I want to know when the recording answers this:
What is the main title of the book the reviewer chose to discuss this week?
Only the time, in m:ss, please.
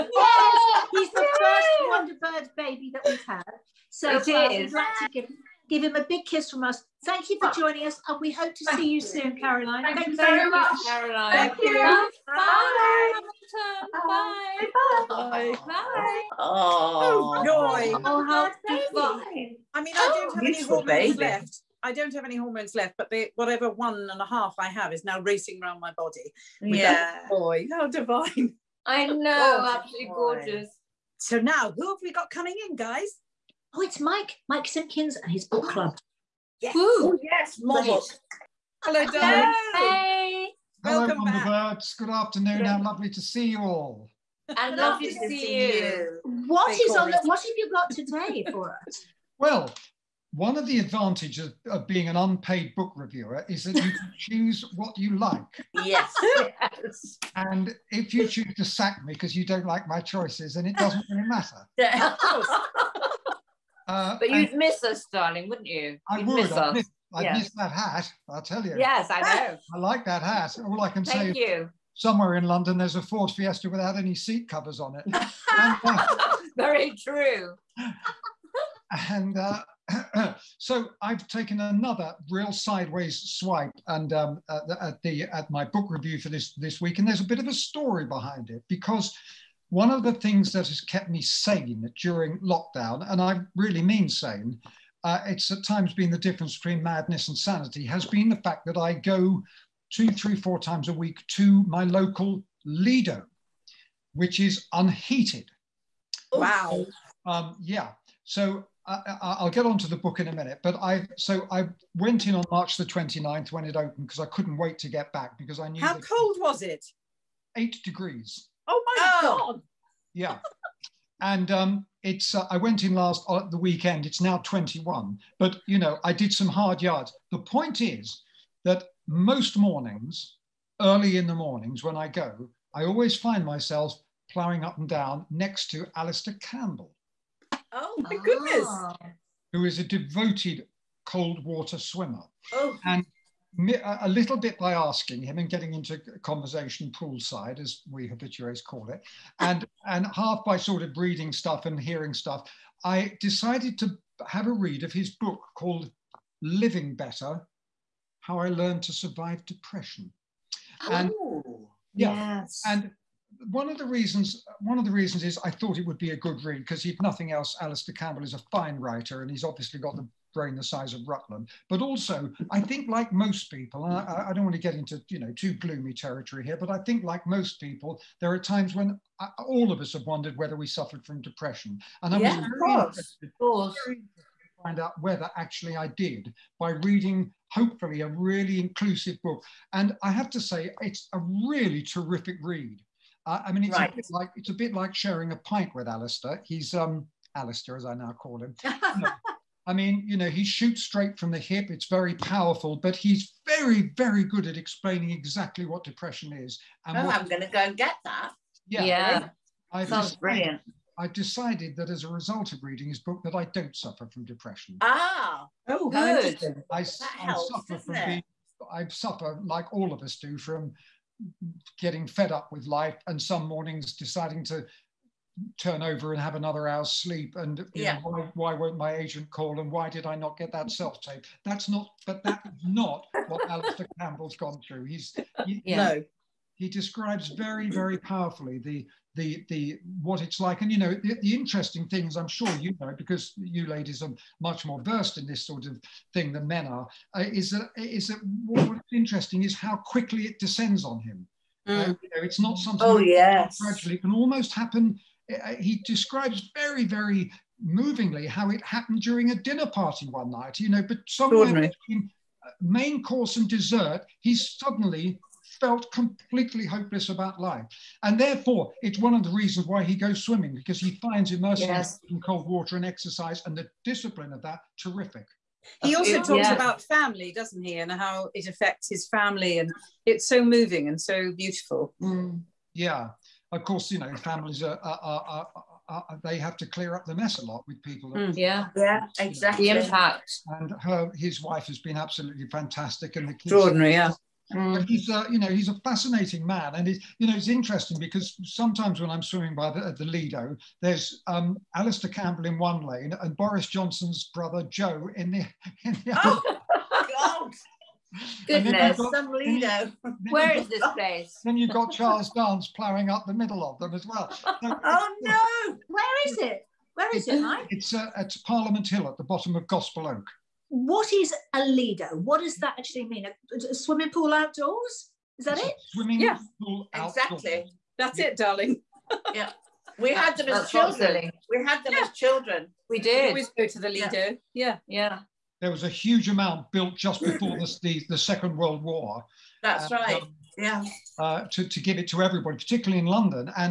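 2:36.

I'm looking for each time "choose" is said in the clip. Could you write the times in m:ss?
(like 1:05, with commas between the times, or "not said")
0:54, 0:58.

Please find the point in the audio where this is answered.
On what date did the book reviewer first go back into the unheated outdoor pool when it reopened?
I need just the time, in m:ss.
1:52.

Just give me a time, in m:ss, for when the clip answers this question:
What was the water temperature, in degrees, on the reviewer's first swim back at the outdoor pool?
1:57.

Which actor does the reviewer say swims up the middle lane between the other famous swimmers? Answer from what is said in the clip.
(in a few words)
Charles Dance.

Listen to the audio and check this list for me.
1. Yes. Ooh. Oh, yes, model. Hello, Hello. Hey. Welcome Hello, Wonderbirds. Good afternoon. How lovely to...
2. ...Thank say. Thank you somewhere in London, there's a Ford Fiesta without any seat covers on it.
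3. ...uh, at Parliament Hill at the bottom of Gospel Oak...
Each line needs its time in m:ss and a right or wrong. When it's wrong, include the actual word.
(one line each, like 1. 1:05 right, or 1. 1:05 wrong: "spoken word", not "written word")
1. 0:36 right
2. 1:11 right
3. 5:17 right.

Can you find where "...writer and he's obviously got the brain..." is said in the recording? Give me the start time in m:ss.
2:48.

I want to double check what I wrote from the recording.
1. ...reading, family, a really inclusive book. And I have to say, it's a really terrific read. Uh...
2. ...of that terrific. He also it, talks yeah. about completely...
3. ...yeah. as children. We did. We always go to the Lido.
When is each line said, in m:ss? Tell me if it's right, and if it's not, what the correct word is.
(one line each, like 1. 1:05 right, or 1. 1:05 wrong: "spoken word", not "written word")
1. 3:06 wrong: "hopefully", not "family"
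2. 4:34 wrong: "family", not "completely"
3. 5:31 right.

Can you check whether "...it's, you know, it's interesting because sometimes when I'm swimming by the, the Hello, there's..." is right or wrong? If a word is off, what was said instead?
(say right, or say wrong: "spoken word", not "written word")
wrong: "Lido", not "Hello".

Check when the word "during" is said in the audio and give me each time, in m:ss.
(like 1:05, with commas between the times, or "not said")
1:31, 4:18.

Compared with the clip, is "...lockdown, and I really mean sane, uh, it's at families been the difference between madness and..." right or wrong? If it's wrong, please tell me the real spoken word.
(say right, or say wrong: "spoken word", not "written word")
wrong: "times", not "families".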